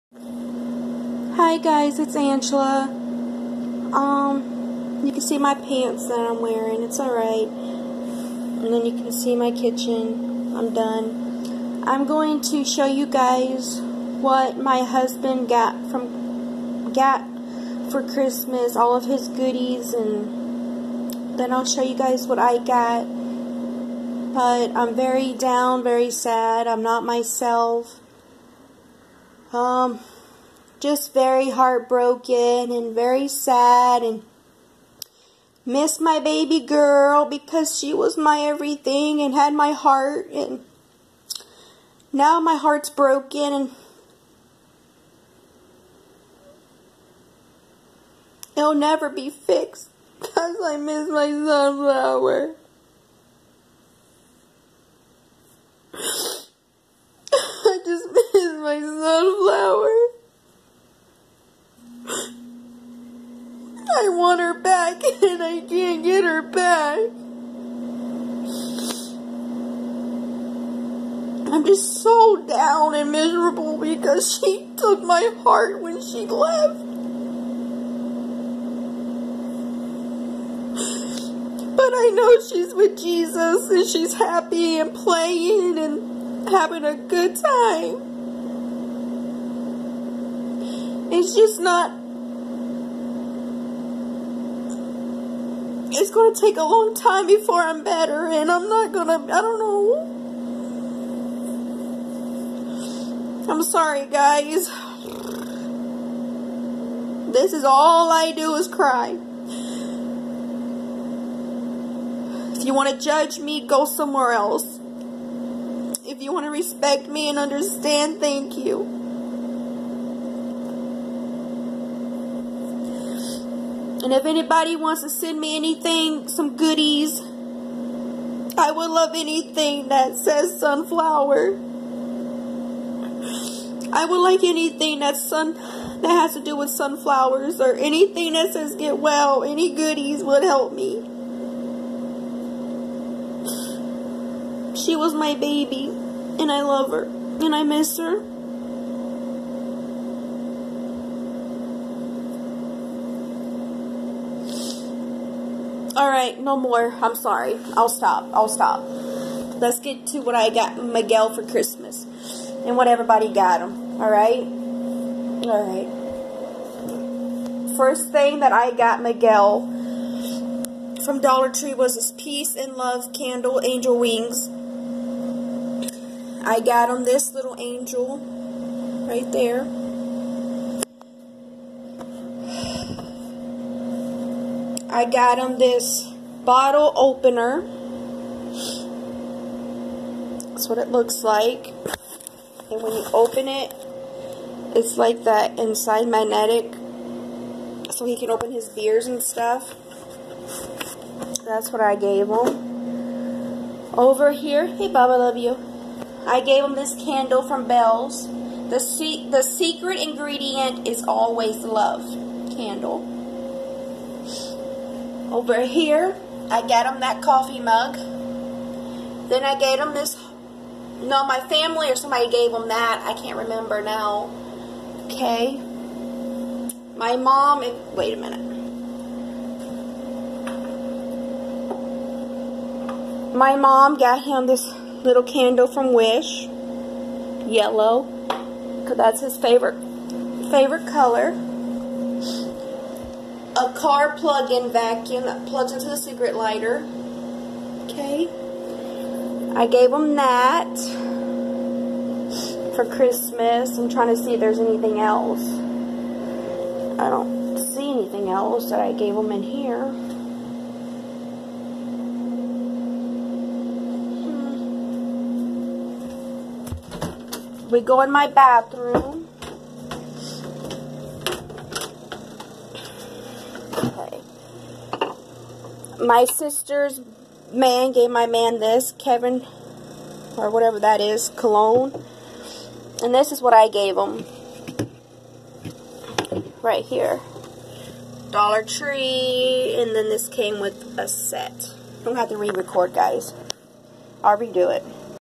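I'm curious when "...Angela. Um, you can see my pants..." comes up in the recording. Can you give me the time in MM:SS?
00:02.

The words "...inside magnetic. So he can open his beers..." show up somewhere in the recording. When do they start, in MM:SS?
03:15.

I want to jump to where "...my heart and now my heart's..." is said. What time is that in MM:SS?
00:39.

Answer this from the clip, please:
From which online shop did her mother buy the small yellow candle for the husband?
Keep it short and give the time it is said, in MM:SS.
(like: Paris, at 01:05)
Wish, at 03:55.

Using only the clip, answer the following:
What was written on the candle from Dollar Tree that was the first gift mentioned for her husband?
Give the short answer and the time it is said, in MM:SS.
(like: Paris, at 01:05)
Peace and Love, at 02:52.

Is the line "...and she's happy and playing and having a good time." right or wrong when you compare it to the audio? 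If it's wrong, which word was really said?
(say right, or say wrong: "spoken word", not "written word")
right.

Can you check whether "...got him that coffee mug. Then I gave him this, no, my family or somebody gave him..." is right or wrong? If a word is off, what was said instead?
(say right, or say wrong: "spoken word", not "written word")
right.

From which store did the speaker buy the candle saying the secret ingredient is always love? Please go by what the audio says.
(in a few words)
Bell's.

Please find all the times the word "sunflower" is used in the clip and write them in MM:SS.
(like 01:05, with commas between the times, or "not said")
00:51, 02:10, 02:16.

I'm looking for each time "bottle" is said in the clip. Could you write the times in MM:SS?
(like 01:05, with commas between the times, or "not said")
03:06.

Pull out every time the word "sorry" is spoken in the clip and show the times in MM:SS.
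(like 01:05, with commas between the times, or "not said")
01:43, 02:37.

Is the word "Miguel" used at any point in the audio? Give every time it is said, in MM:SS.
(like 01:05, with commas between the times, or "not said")
02:40, 02:49.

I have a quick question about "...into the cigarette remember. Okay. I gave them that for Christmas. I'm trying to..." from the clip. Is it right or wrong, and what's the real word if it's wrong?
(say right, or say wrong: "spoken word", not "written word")
wrong: "lighter", not "remember".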